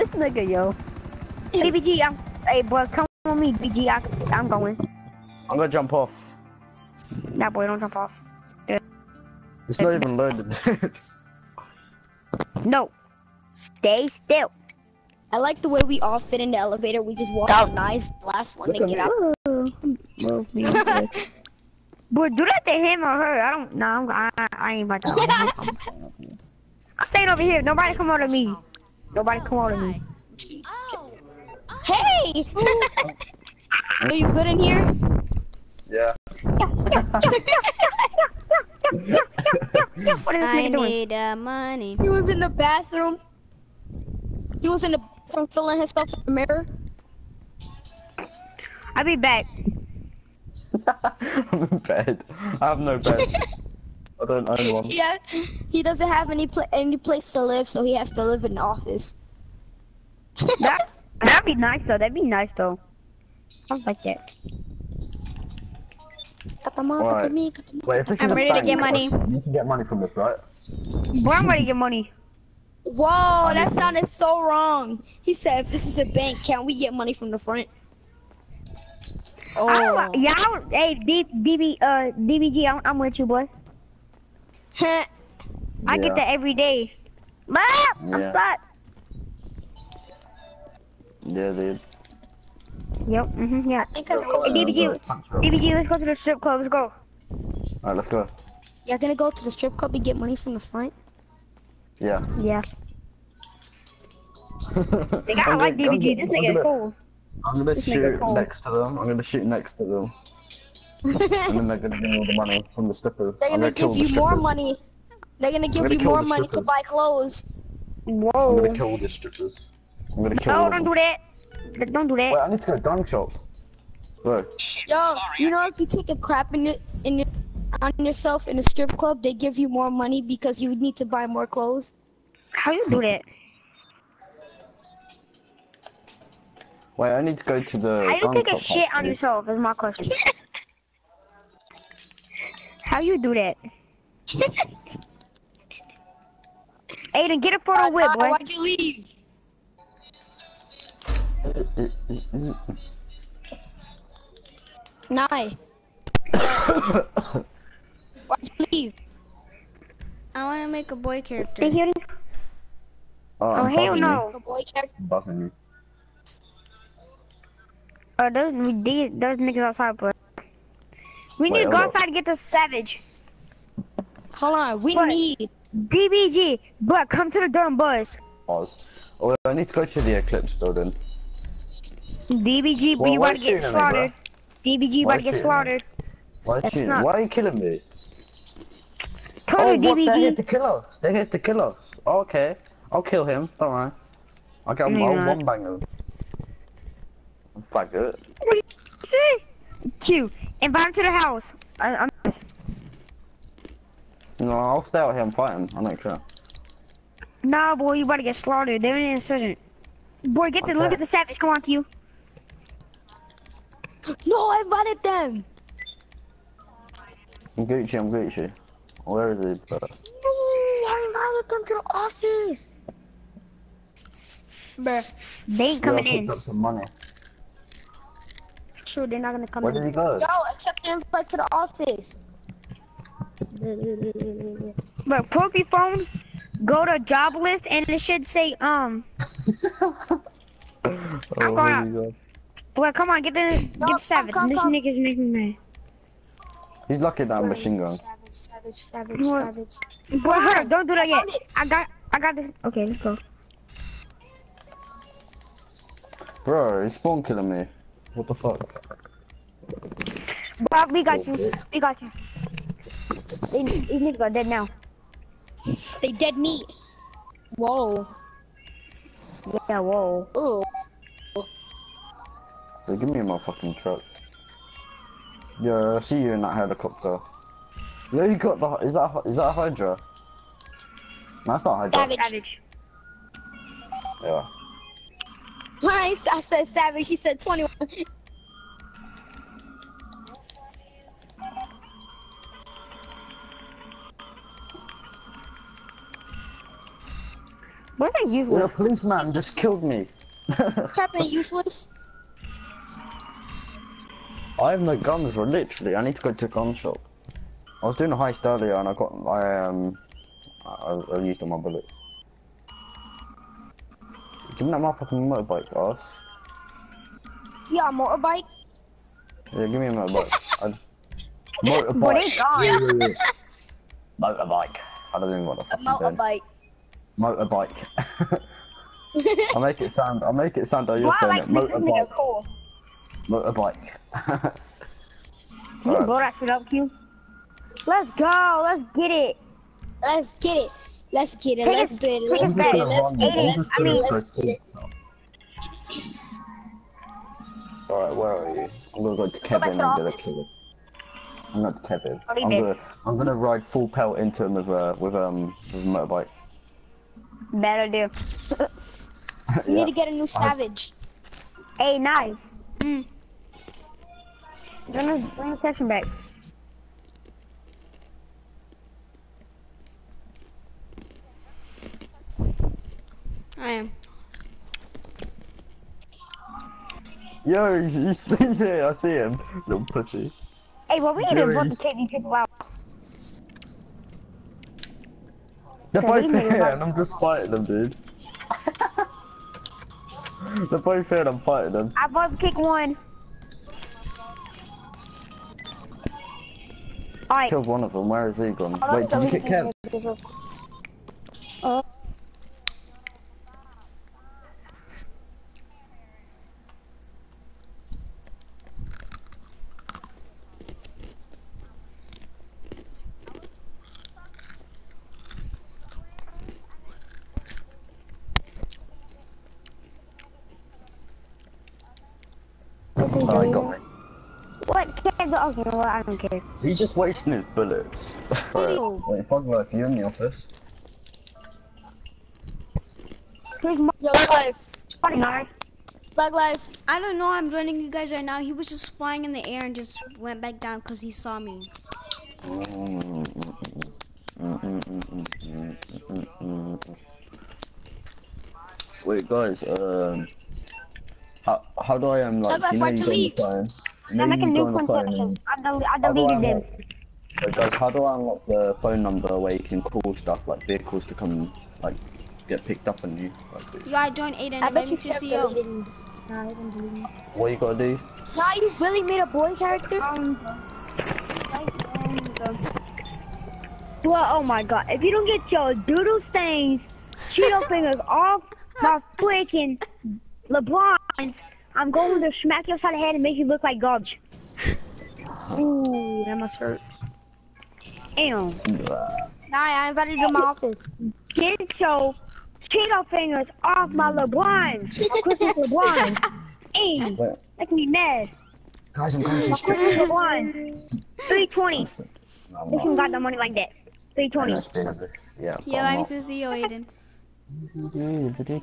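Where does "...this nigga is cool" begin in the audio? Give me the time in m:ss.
1:46.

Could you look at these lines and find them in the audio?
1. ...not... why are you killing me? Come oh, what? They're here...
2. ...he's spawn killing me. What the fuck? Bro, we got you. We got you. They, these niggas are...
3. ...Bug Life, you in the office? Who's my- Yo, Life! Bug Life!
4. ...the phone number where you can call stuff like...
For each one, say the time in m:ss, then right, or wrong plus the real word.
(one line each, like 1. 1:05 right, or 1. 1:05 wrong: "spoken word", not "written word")
1. 3:06 right
2. 4:16 right
3. 7:09 right
4. 7:38 right.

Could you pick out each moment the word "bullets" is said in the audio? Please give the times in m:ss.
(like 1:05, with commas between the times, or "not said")
5:11, 7:07.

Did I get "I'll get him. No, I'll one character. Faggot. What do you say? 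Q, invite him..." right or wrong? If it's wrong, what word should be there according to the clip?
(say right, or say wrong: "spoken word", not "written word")
wrong: "banger", not "character".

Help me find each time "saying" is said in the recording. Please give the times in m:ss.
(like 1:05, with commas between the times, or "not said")
5:31.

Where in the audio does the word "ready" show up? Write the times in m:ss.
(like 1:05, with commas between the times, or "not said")
1:06, 1:11.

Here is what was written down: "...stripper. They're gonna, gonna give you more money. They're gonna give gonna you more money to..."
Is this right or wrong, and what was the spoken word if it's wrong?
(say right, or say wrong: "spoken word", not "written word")
right.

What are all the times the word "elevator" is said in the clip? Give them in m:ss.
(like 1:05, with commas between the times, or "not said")
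0:16.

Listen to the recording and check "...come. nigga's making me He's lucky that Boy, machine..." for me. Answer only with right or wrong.
right.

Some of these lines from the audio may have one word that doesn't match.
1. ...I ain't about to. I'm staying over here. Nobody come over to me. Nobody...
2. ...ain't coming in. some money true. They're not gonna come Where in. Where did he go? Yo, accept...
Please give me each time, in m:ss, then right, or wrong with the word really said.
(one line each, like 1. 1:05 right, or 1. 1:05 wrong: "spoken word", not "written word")
1. 0:24 right
2. 3:45 right.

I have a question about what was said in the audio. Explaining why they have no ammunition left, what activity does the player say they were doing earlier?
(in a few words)
a heist.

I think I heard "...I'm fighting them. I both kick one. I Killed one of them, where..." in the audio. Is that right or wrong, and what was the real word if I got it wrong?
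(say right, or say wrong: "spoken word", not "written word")
right.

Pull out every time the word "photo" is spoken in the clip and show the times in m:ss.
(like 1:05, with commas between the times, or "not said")
2:27.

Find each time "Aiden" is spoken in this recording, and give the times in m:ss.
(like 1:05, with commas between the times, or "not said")
2:27, 7:44, 8:26.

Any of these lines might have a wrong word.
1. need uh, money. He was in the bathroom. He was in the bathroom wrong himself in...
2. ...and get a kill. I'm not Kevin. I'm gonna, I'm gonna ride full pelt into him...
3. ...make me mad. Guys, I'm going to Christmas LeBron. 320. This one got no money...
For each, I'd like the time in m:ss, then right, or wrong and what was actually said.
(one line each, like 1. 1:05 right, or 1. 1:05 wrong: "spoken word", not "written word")
1. 0:40 wrong: "filling", not "wrong"
2. 5:49 right
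3. 8:17 right.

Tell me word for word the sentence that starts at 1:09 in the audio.
You can get money from this, right?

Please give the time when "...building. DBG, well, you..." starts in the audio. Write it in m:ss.
3:00.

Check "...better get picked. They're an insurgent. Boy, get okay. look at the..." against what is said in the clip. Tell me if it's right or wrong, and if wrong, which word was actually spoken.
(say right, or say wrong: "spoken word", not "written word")
wrong: "slaughtered", not "picked".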